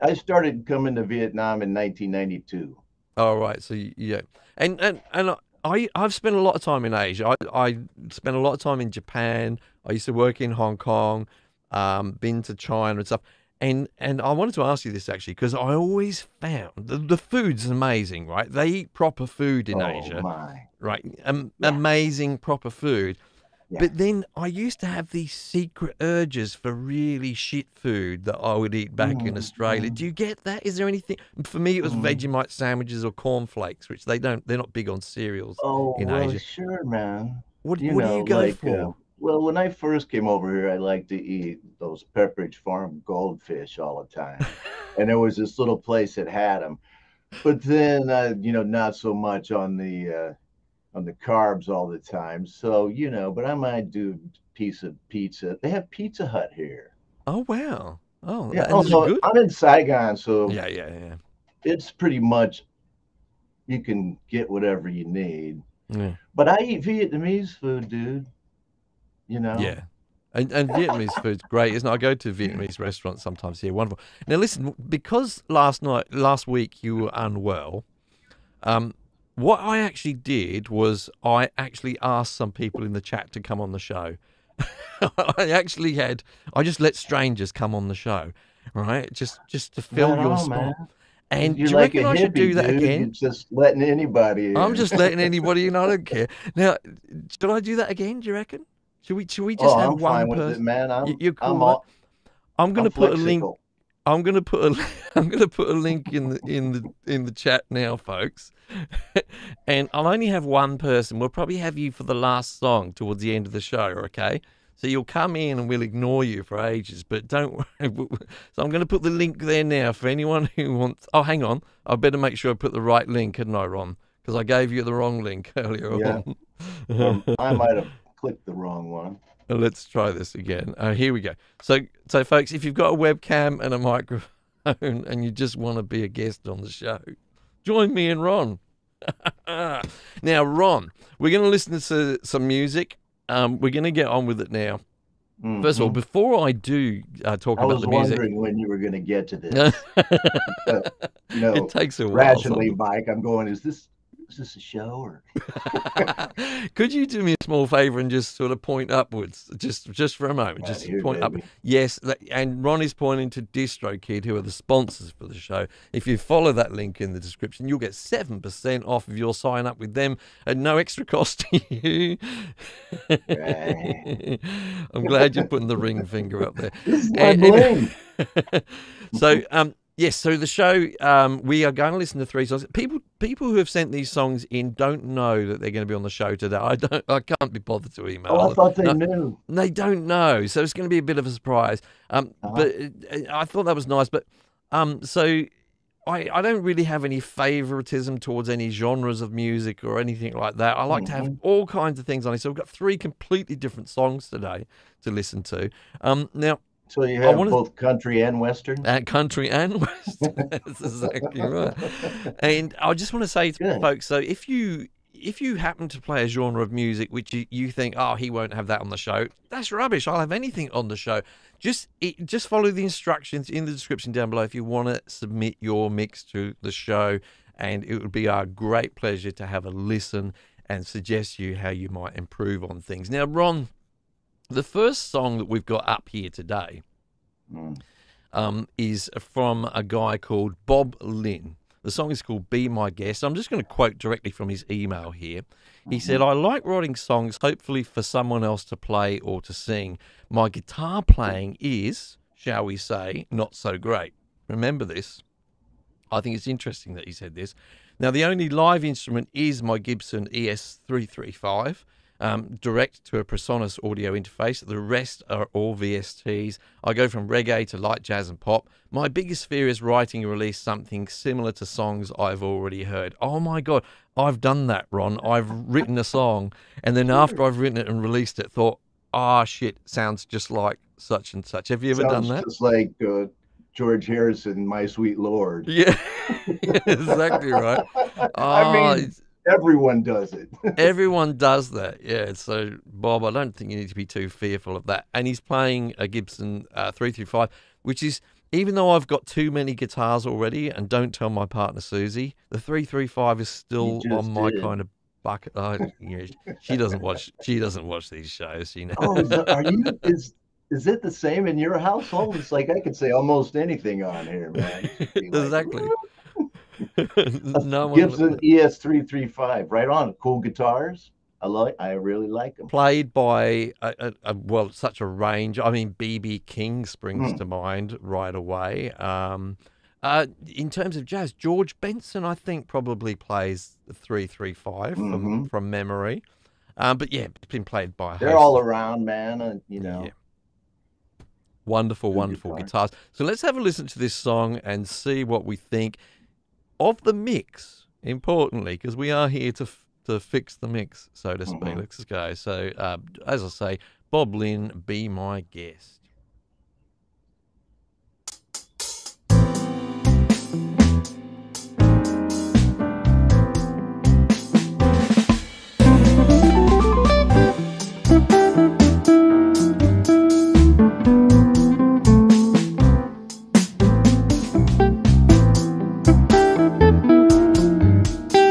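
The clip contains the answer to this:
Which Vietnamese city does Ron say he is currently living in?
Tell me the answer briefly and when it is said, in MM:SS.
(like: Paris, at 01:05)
Saigon, at 00:59.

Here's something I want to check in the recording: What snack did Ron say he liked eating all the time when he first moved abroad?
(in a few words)
Pepperidge Farm goldfish.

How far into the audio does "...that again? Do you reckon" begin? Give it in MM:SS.
01:37.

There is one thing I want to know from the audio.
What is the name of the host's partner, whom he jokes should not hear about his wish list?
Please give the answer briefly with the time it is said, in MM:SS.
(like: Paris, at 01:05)
Susie, at 05:01.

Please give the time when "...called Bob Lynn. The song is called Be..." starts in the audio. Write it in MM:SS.
04:00.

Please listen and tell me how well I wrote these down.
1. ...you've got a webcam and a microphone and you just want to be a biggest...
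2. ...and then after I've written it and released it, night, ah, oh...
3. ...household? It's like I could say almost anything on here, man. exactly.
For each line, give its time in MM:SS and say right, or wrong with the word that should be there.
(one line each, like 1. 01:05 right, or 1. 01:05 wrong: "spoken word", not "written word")
1. 02:12 wrong: "guest", not "biggest"
2. 04:36 wrong: "thought", not "night"
3. 05:11 right.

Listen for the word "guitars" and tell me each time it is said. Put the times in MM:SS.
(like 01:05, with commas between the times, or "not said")
04:10, 04:59, 05:20, 05:42.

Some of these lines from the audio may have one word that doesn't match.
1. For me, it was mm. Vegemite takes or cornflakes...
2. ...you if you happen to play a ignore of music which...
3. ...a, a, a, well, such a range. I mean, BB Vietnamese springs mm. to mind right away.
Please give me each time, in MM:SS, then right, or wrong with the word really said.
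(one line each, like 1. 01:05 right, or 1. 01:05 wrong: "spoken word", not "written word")
1. 00:31 wrong: "sandwiches", not "takes"
2. 03:34 wrong: "genre", not "ignore"
3. 05:23 wrong: "King", not "Vietnamese".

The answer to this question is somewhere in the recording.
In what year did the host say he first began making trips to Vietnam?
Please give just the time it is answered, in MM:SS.
00:01.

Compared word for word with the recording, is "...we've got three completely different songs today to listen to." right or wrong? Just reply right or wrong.
right.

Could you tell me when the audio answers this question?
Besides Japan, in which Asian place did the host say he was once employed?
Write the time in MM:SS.
00:10.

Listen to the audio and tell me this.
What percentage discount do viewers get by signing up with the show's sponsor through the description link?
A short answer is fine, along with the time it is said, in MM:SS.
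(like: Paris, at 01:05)
7%, at 02:47.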